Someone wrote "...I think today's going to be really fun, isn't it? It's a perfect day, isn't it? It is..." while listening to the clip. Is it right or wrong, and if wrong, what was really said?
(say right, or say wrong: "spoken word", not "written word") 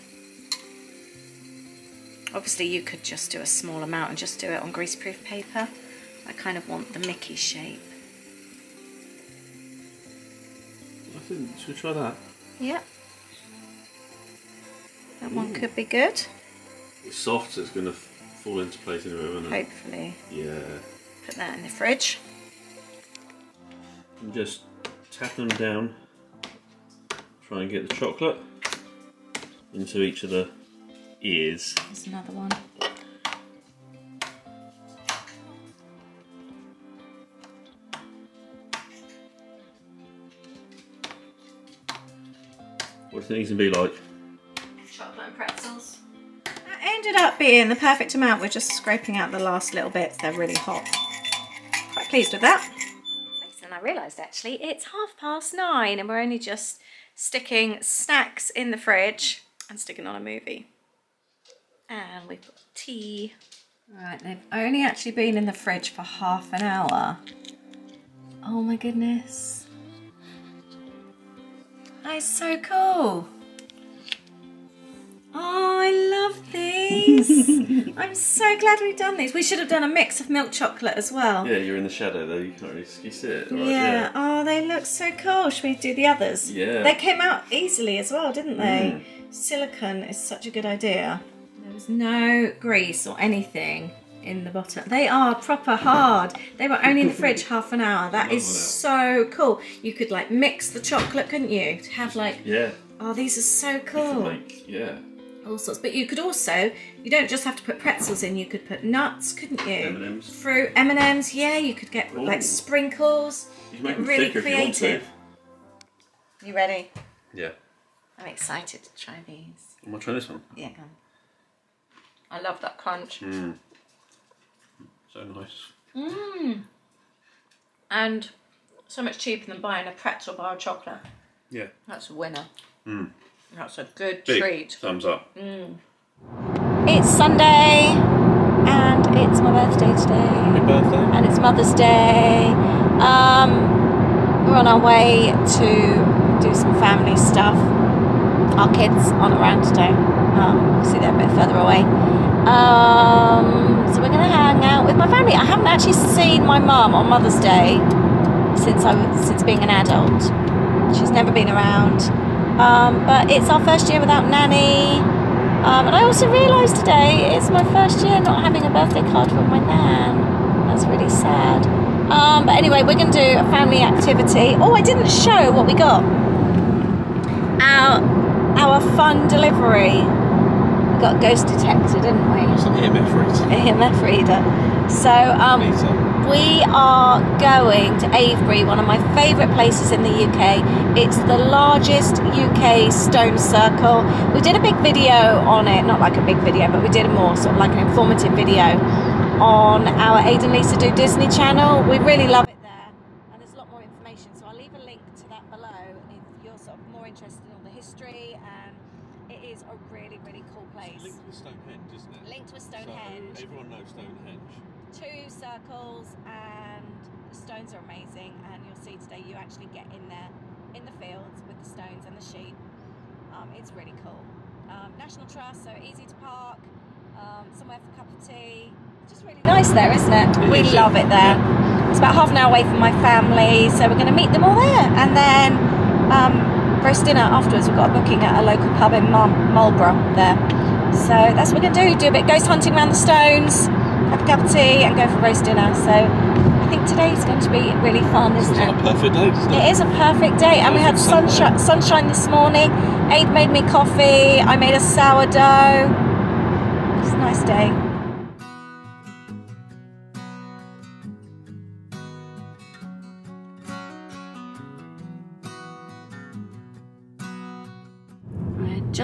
right.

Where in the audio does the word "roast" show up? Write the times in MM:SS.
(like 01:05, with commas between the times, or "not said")
03:56, 04:05.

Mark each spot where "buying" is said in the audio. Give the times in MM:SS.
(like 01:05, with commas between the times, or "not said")
02:09.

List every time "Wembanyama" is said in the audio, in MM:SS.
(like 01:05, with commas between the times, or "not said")
not said.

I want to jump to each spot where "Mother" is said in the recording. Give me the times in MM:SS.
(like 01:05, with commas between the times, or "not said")
02:21, 02:37.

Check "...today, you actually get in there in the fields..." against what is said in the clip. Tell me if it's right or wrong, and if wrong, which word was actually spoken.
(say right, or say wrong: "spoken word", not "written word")
right.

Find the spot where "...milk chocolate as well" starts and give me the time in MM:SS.
01:20.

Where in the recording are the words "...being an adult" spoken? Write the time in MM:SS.
02:39.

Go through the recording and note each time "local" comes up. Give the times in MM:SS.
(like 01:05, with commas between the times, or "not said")
03:58.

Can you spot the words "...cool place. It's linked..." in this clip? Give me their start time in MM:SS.
03:30.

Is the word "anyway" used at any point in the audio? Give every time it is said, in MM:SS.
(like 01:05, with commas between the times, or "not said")
00:19, 02:52.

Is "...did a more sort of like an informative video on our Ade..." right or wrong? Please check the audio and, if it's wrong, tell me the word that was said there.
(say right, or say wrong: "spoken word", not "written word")
right.